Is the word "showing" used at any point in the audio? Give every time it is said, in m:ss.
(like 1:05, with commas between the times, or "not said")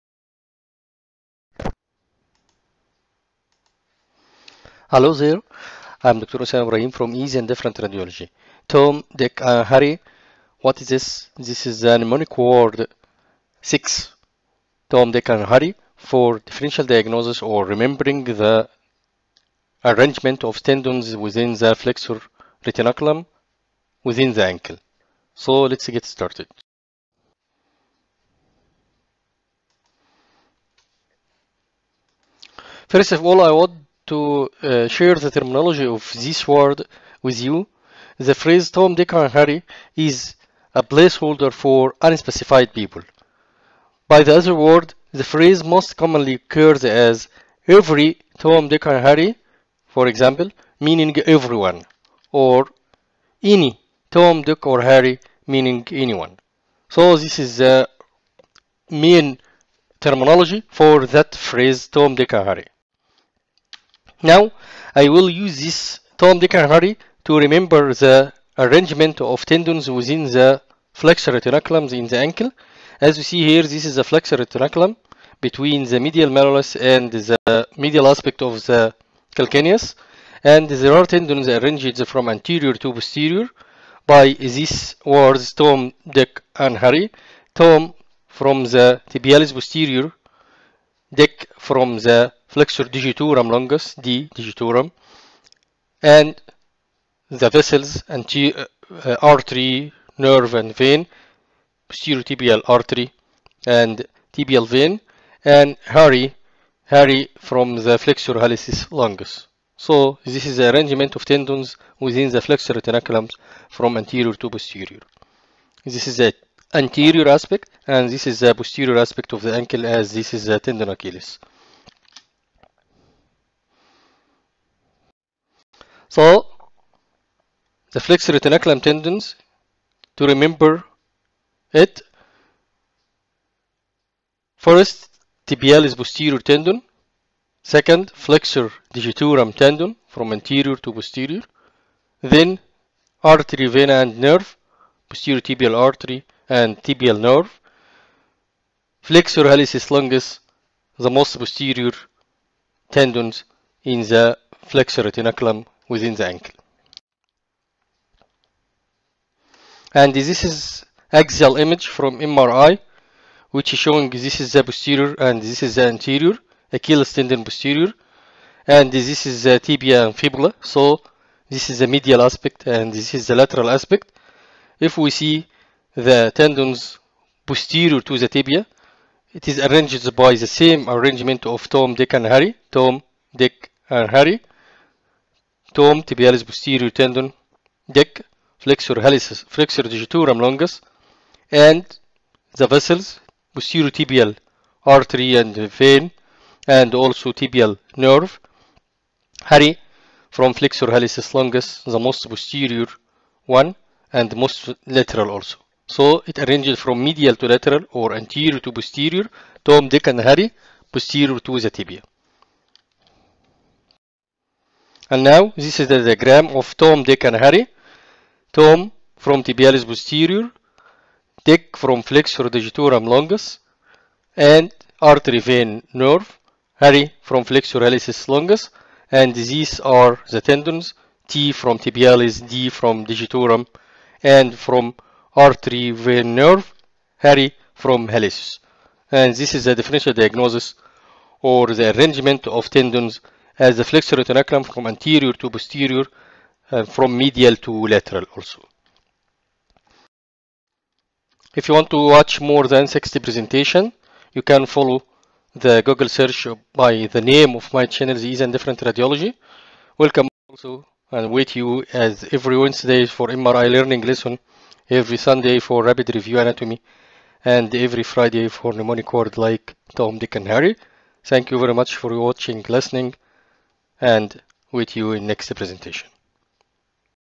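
2:43.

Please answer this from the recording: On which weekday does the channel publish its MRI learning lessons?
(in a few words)
Wednesday.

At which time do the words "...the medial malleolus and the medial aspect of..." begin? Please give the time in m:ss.
1:15.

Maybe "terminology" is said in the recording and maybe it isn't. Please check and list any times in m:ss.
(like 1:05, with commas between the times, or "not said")
0:35, 0:59.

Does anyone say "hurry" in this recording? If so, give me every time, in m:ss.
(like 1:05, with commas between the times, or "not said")
3:19, 3:30.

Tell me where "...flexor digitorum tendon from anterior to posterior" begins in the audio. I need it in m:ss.
2:18.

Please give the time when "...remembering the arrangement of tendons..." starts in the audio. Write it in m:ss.
0:17.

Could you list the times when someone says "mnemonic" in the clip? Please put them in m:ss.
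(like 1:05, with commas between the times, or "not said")
0:11, 4:28.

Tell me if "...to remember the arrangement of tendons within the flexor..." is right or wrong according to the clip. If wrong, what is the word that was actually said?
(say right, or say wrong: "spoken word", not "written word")
right.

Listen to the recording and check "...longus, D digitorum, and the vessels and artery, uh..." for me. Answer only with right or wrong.
right.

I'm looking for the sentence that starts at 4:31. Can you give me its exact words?
Thank you very much for watching, listening and with you in next presentation.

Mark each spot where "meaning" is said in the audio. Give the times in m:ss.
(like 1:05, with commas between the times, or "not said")
0:50, 0:55.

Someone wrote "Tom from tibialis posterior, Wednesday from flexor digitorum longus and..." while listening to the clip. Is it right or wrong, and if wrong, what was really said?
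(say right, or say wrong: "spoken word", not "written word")
wrong: "Dick", not "Wednesday".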